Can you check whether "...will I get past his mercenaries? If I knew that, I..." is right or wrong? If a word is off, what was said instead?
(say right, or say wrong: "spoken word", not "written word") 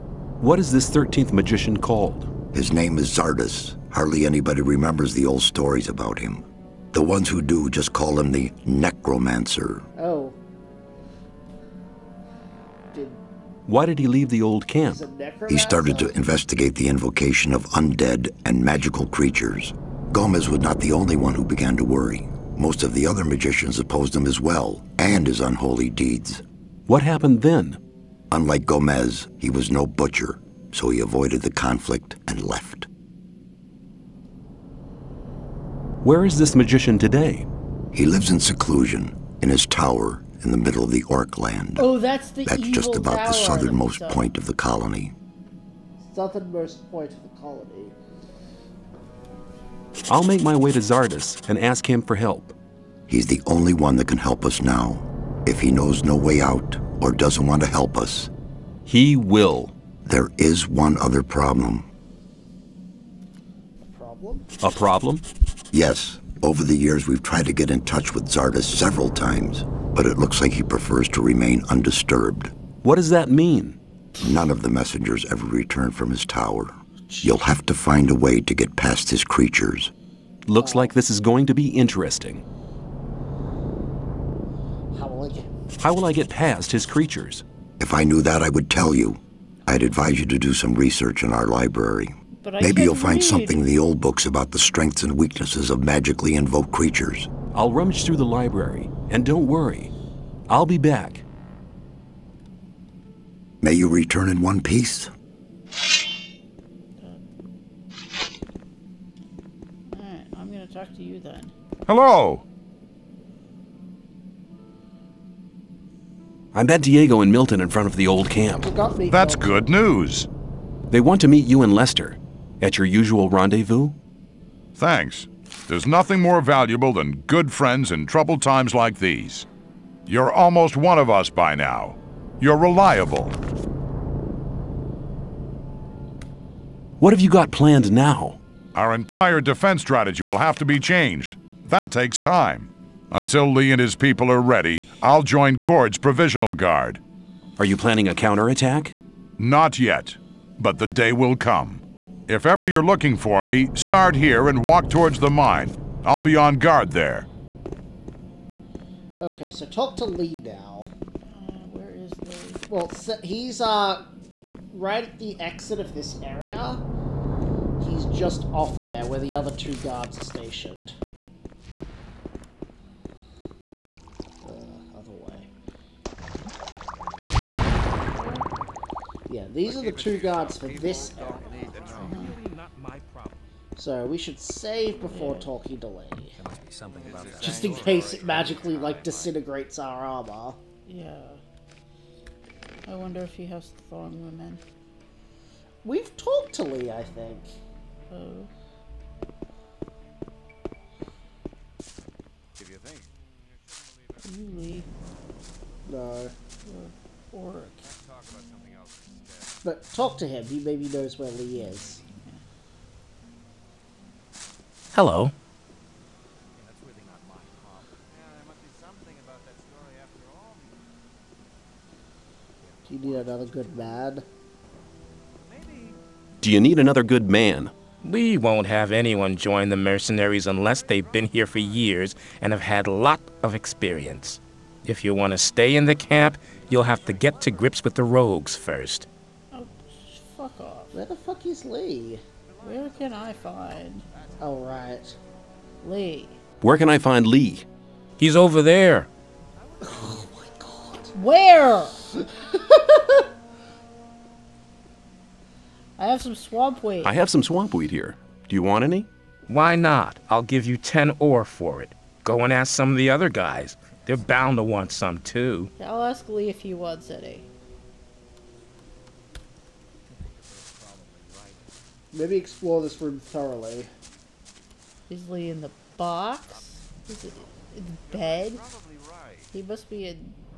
wrong: "creatures", not "mercenaries".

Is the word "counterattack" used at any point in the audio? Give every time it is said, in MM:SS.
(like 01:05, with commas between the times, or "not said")
02:28.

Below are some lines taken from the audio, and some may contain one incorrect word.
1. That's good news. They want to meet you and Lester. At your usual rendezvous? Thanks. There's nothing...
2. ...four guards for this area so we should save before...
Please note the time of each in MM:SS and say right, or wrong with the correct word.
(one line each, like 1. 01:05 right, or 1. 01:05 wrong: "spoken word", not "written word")
1. 01:59 right
2. 02:59 wrong: "two", not "four".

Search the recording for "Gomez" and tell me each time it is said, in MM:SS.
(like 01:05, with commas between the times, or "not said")
00:20, 00:28.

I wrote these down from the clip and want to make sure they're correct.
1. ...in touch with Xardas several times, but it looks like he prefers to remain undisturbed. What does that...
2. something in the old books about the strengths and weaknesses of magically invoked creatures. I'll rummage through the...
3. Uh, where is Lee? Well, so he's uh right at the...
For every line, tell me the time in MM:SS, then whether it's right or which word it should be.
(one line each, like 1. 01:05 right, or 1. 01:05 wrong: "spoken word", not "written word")
1. 01:07 right
2. 01:33 right
3. 02:40 right.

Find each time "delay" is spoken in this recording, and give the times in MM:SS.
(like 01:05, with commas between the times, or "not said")
03:05.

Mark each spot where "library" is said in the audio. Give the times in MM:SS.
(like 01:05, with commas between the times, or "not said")
01:31, 01:38.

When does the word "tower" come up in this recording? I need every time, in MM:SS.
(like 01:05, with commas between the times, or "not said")
00:39, 01:16.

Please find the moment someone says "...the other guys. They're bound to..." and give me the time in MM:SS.
04:22.